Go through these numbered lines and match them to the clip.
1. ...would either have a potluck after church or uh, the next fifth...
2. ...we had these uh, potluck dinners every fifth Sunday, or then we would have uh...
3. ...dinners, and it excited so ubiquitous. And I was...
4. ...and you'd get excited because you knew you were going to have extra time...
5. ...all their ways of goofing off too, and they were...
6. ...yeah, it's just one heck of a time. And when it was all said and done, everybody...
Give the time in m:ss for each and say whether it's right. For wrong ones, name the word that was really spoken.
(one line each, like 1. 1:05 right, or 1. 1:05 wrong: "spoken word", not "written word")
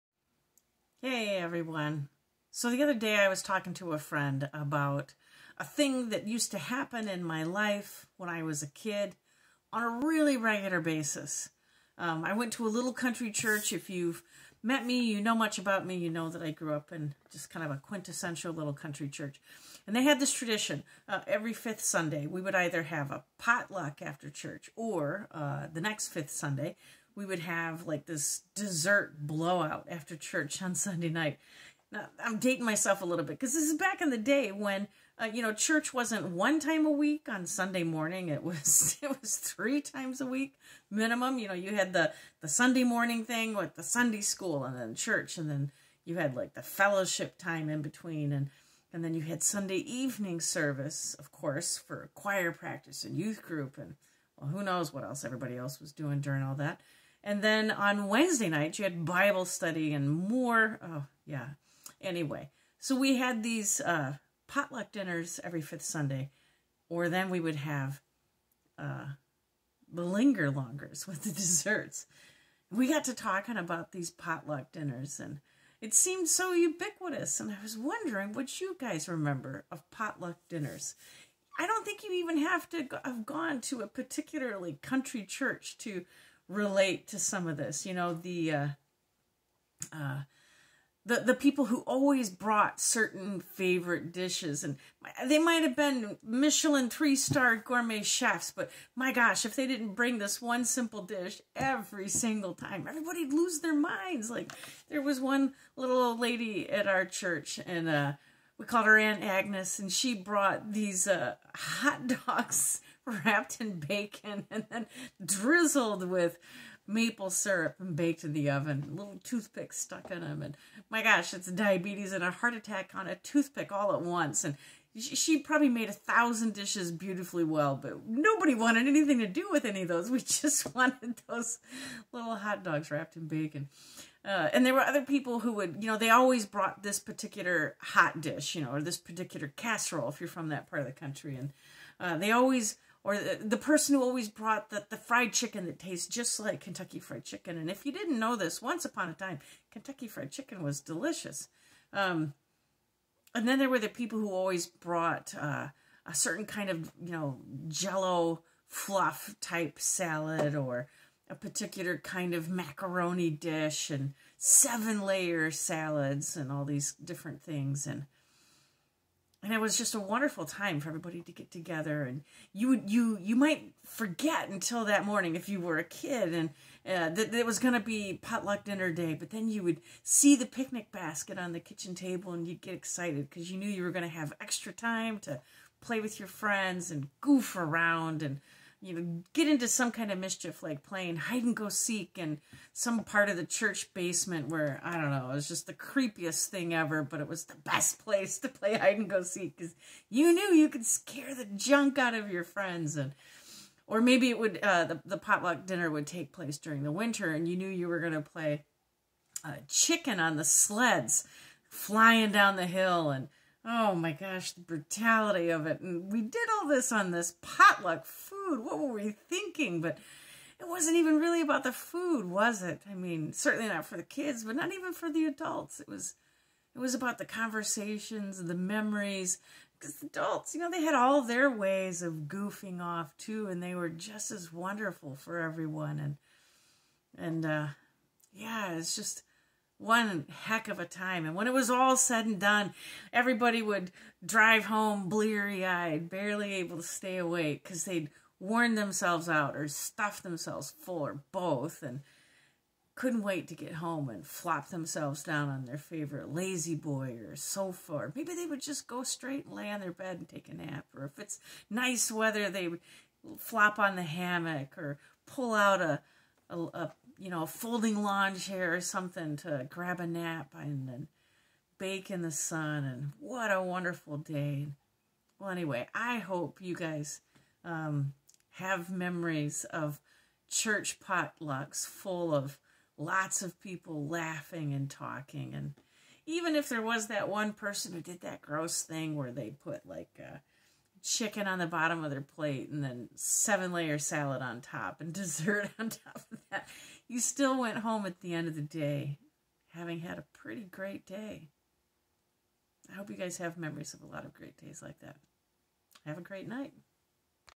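1. 0:22 right
2. 1:02 right
3. 1:14 wrong: "seemed", not "excited"
4. 3:02 right
5. 3:50 right
6. 3:58 right.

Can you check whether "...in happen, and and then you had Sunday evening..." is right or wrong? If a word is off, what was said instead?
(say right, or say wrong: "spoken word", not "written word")
wrong: "between", not "happen".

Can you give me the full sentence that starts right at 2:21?
And uh, they always or the, the person who always brought the, the fried chicken that tastes just like Kentucky Fried Chicken.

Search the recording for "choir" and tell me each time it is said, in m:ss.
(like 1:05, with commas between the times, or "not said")
0:52.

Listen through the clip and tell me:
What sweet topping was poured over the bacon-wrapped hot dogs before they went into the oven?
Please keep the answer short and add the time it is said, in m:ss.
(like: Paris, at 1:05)
Maple syrup, at 1:56.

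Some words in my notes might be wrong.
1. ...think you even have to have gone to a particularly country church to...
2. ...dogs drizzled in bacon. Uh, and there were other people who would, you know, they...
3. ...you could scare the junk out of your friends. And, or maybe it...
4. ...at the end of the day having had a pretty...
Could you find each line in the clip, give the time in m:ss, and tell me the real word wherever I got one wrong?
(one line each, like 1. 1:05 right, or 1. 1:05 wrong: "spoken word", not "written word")
1. 1:21 right
2. 2:12 wrong: "wrapped", not "drizzled"
3. 3:20 right
4. 4:58 right.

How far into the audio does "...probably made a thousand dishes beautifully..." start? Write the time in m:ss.
2:05.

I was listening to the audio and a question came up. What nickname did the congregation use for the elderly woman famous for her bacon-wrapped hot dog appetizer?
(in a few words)
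Aunt Agnes.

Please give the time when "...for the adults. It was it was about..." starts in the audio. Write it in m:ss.
3:44.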